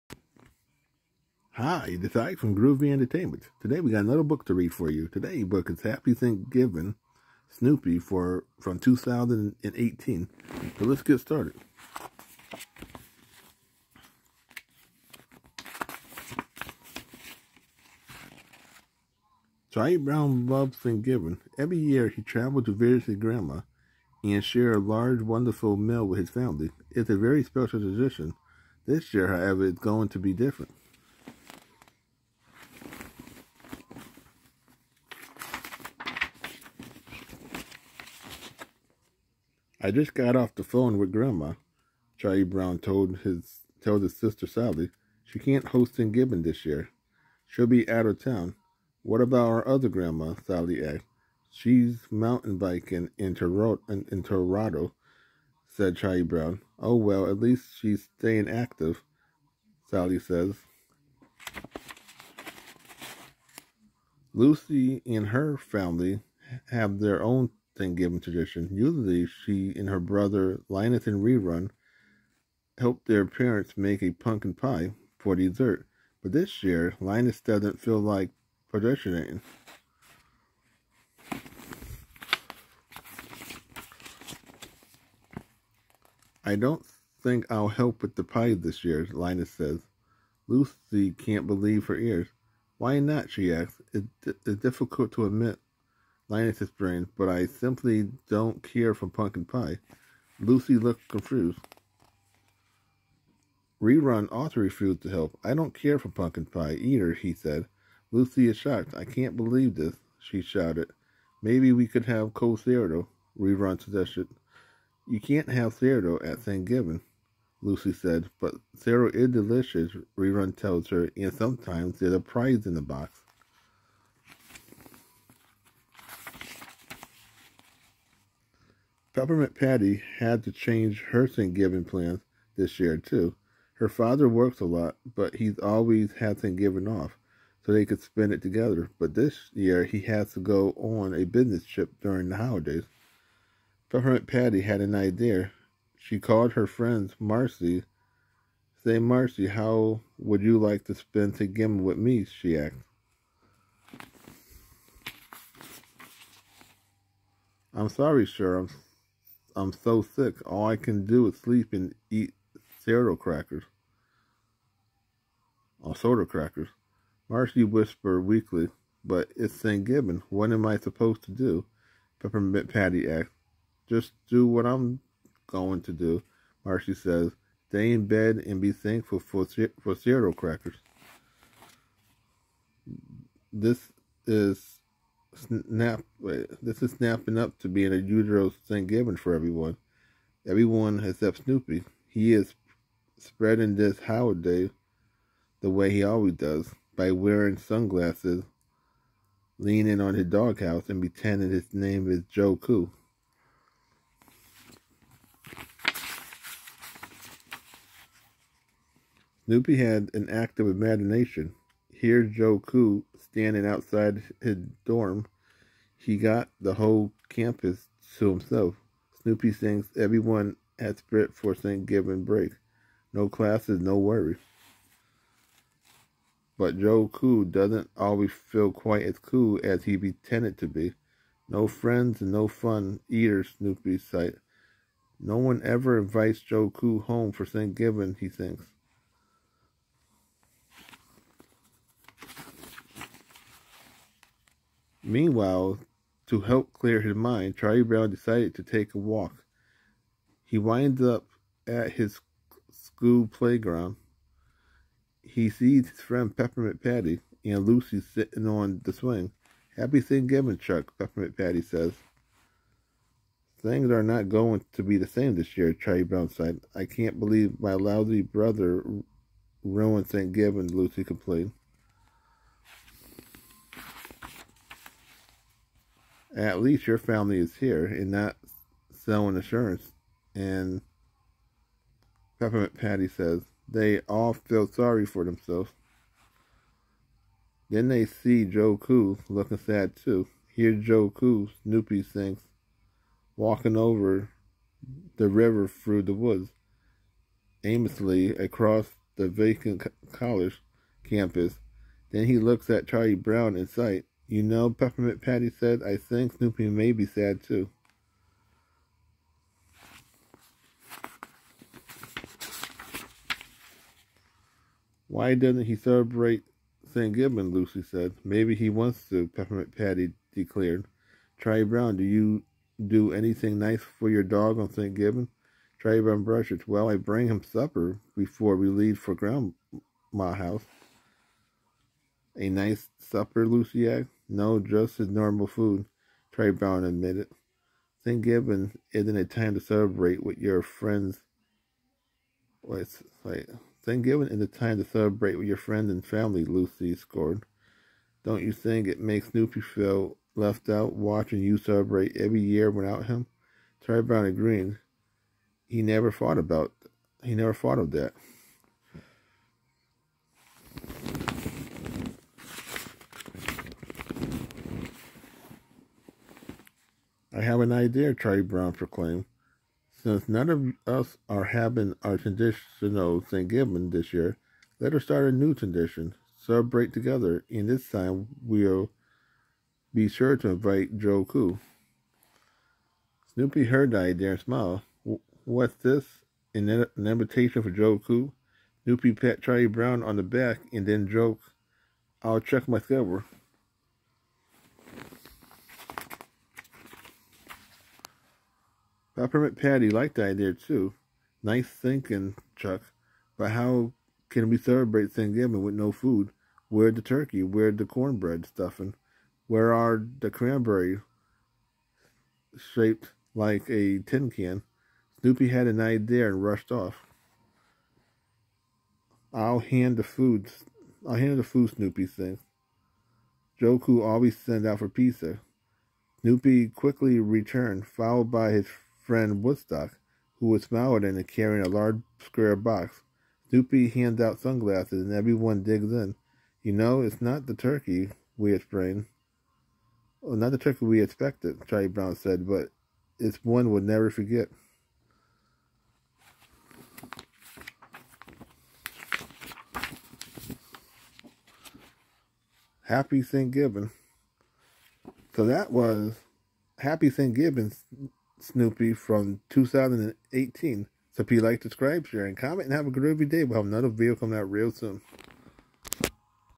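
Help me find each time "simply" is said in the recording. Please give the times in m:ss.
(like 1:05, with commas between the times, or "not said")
1:37.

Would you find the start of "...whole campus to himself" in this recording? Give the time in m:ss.
3:36.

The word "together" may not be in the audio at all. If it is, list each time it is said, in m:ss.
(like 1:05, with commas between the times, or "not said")
2:18, 6:16.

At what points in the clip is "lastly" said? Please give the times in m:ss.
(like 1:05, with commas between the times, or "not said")
not said.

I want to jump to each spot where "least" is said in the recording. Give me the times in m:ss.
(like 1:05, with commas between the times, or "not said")
0:57, 4:36.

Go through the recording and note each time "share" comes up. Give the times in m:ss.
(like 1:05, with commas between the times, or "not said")
0:24, 7:42.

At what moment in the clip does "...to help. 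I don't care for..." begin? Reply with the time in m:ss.
1:45.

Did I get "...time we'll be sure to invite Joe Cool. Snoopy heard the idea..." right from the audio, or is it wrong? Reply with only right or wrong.
right.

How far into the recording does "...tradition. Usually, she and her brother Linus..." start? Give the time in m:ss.
1:08.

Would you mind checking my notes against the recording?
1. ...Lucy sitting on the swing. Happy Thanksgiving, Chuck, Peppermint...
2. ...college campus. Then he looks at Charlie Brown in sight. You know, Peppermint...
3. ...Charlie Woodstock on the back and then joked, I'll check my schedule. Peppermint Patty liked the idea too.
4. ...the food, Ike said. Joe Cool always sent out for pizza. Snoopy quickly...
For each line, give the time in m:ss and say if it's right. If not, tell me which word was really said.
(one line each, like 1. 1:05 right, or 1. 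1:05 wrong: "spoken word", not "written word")
1. 4:17 right
2. 5:00 right
3. 6:29 wrong: "Brown", not "Woodstock"
4. 7:01 wrong: "Snoopy", not "Ike".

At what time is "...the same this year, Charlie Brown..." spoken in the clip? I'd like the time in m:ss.
4:24.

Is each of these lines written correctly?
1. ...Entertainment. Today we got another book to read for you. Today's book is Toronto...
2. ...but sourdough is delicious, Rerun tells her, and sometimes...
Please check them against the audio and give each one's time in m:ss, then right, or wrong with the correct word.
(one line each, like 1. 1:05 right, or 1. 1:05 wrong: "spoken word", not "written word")
1. 0:02 wrong: "Happy", not "Toronto"
2. 1:58 right.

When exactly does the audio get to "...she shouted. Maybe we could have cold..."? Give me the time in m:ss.
1:50.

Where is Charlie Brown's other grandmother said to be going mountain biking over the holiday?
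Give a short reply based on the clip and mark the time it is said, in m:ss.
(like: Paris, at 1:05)
Toronto, at 0:54.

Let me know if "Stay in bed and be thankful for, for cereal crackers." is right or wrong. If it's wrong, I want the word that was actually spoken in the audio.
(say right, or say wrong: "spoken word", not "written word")
right.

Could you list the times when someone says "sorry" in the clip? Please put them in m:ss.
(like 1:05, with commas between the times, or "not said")
2:37, 4:44.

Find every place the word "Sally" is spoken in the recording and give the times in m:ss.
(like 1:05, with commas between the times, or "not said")
0:44, 0:50, 0:59.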